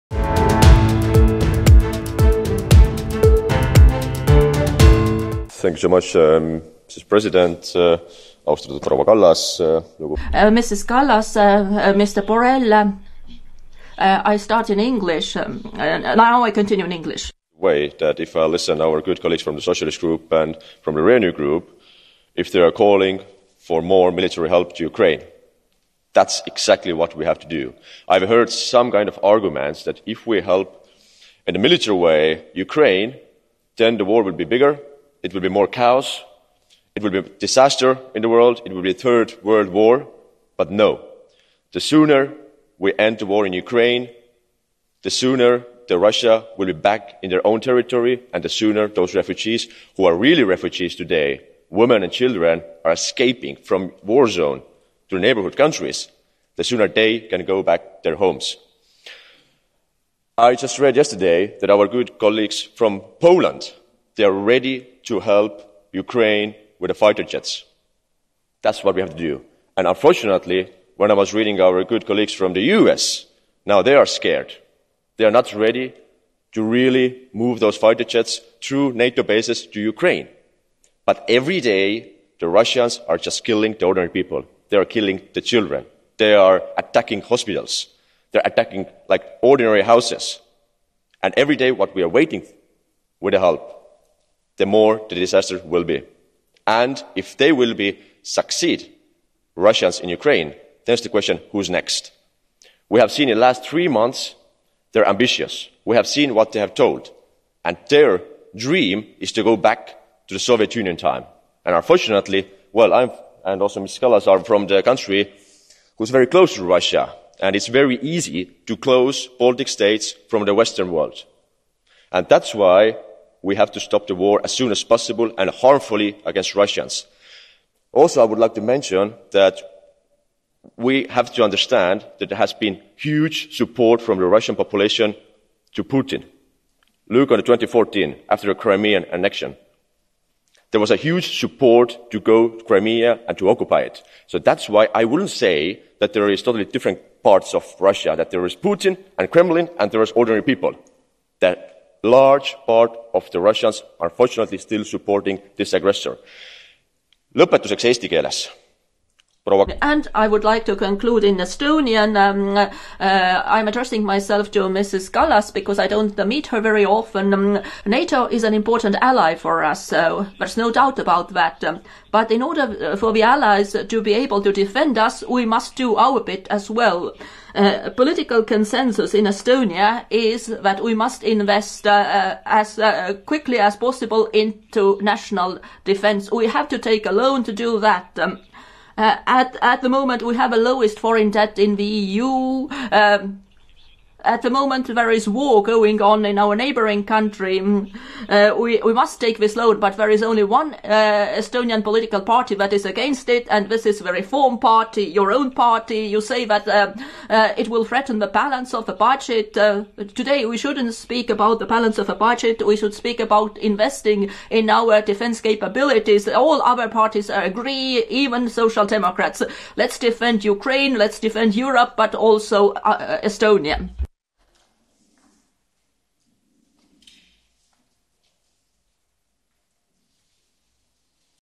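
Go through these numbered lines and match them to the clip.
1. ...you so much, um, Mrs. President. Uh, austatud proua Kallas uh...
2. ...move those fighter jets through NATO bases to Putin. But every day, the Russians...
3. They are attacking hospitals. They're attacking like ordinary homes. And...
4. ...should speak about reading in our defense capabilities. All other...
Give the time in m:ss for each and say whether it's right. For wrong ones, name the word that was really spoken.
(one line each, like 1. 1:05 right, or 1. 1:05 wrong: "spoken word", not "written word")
1. 0:05 right
2. 1:17 wrong: "Ukraine", not "Putin"
3. 1:26 wrong: "houses", not "homes"
4. 3:32 wrong: "investing", not "reading".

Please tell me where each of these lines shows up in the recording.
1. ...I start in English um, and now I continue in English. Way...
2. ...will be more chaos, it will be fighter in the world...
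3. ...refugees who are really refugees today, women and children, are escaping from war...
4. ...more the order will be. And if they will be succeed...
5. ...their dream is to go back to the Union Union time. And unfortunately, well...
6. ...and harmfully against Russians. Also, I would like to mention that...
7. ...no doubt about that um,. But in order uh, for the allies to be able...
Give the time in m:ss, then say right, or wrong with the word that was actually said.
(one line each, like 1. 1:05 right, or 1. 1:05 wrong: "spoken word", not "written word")
1. 0:14 right
2. 0:35 wrong: "disaster", not "fighter"
3. 0:49 right
4. 1:34 wrong: "disaster", not "order"
5. 1:47 wrong: "Soviet", not "Union"
6. 2:05 right
7. 2:50 right.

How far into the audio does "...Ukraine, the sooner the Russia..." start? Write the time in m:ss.
0:43.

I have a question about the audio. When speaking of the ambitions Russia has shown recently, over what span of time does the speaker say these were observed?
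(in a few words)
last three months.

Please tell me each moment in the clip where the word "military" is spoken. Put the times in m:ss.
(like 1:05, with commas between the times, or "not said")
0:24, 0:31.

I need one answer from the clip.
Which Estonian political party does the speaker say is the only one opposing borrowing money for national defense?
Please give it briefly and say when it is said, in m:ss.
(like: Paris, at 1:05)
Reform Party, at 3:24.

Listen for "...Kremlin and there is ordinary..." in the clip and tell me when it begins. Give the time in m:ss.
2:29.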